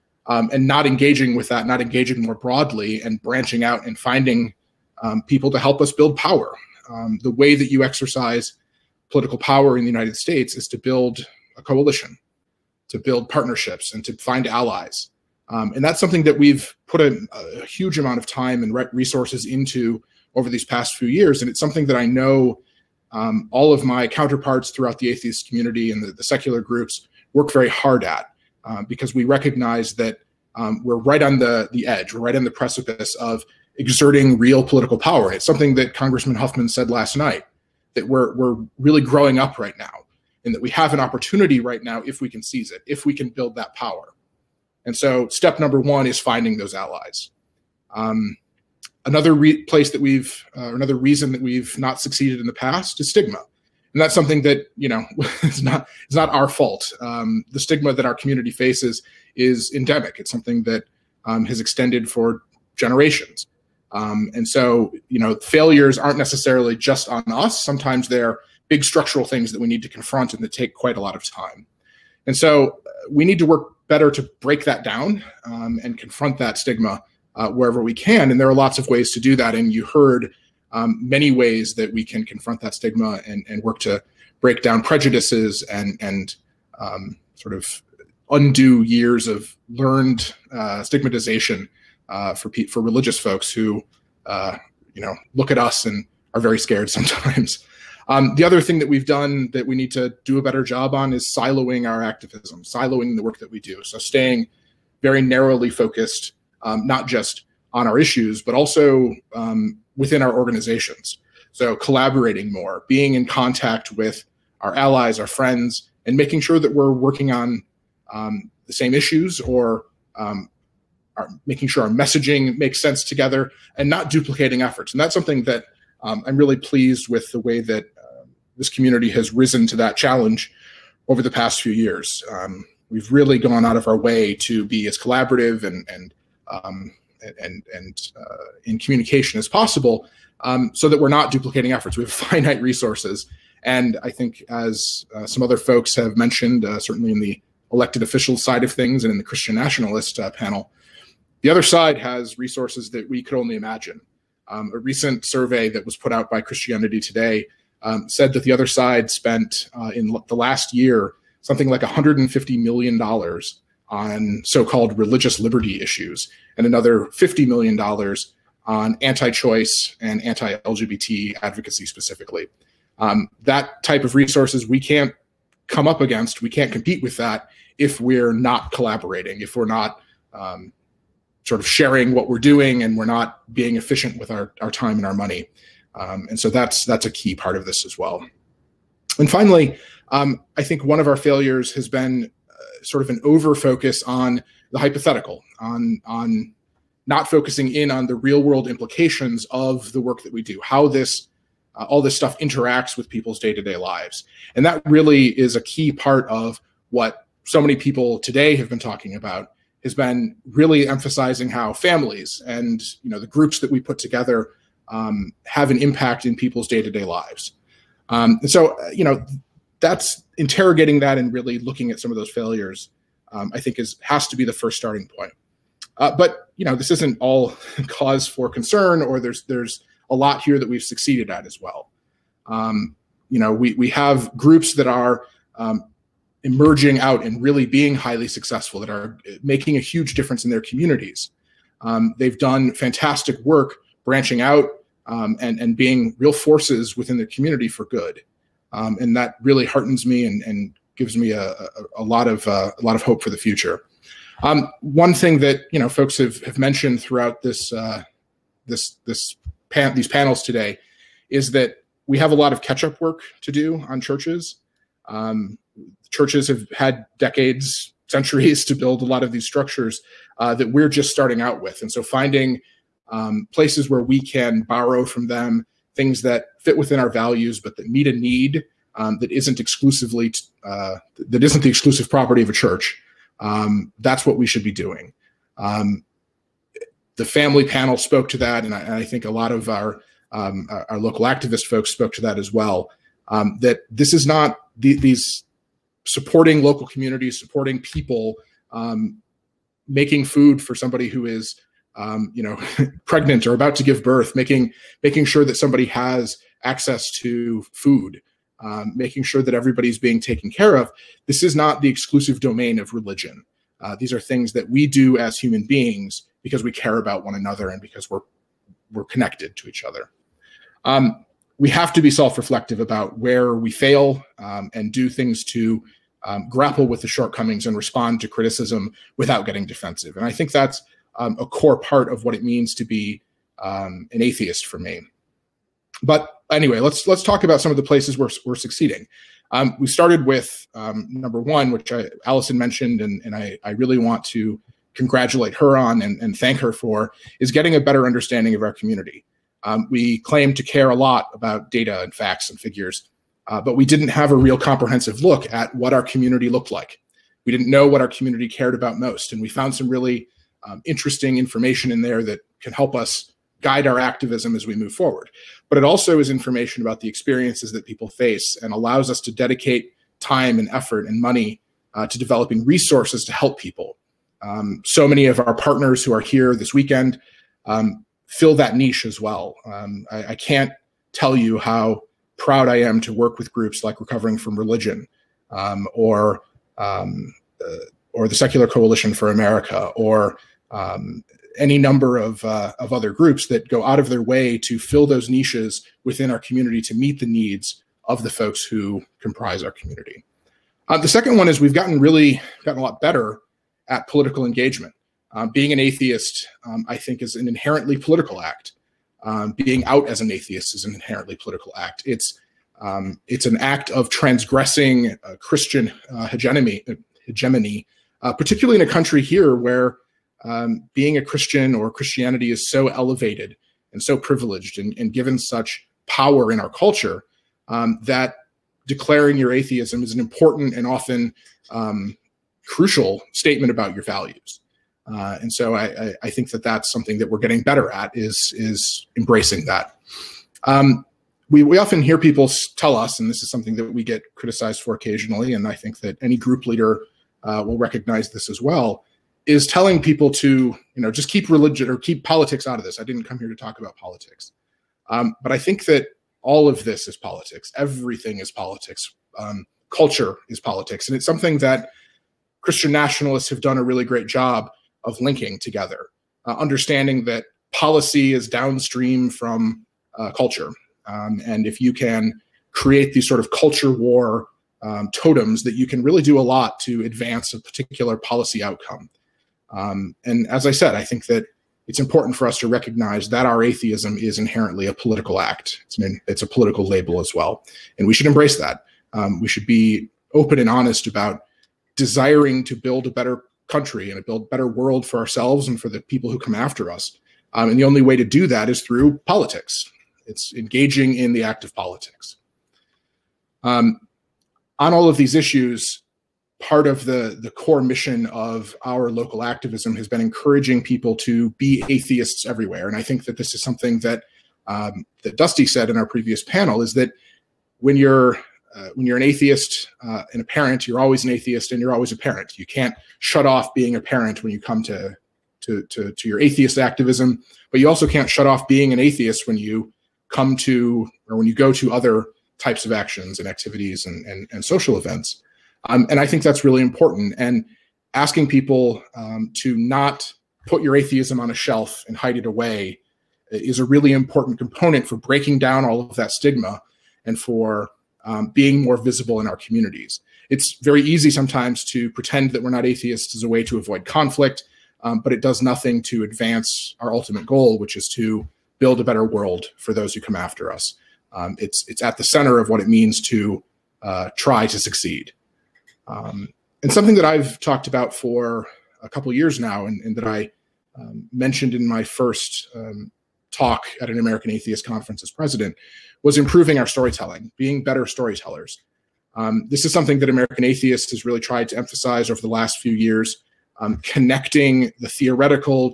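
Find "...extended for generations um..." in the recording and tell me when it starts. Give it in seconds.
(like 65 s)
61 s.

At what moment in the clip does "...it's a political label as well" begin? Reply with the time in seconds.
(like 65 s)
486 s.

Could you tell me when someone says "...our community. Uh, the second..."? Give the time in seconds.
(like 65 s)
399 s.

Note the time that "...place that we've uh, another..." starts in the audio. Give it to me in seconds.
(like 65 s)
49 s.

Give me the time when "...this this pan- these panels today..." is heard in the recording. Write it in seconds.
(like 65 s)
258 s.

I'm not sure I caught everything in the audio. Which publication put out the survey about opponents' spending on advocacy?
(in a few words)
Christianity Today.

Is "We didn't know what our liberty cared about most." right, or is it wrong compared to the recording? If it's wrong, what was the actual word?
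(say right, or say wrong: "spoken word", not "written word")
wrong: "community", not "liberty".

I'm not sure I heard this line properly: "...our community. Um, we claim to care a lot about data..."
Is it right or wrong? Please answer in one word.
right.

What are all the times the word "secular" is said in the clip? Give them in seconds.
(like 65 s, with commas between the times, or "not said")
26 s, 388 s.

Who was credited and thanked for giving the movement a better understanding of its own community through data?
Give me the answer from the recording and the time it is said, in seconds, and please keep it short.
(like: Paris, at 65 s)
Allison, at 342 s.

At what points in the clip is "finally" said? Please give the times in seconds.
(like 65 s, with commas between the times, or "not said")
189 s.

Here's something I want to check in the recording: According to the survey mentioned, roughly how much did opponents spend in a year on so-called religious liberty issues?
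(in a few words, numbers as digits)
$150 million.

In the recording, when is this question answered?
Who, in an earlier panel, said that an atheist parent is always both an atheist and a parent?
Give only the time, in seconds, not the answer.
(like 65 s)
515 s.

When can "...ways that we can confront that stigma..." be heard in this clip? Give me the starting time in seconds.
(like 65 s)
81 s.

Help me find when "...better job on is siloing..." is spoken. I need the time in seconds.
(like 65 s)
100 s.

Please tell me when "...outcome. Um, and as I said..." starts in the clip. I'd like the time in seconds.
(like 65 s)
478 s.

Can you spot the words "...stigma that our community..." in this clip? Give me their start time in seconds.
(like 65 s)
57 s.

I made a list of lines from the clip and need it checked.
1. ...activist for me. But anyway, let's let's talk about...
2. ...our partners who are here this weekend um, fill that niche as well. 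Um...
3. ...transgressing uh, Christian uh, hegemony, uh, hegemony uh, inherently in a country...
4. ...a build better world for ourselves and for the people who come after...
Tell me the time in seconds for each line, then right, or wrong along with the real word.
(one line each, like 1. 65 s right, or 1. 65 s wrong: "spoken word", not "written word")
1. 334 s wrong: "atheist", not "activist"
2. 375 s right
3. 414 s wrong: "particularly", not "inherently"
4. 494 s right.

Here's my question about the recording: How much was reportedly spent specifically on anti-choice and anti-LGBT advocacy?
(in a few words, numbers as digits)
$50 million.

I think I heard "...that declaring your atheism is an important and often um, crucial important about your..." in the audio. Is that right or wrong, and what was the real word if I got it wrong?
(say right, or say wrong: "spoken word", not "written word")
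wrong: "statement", not "important".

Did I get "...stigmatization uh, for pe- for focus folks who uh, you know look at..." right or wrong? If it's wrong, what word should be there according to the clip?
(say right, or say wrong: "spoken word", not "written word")
wrong: "religious", not "focus".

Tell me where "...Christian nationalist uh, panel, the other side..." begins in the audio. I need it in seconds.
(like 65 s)
149 s.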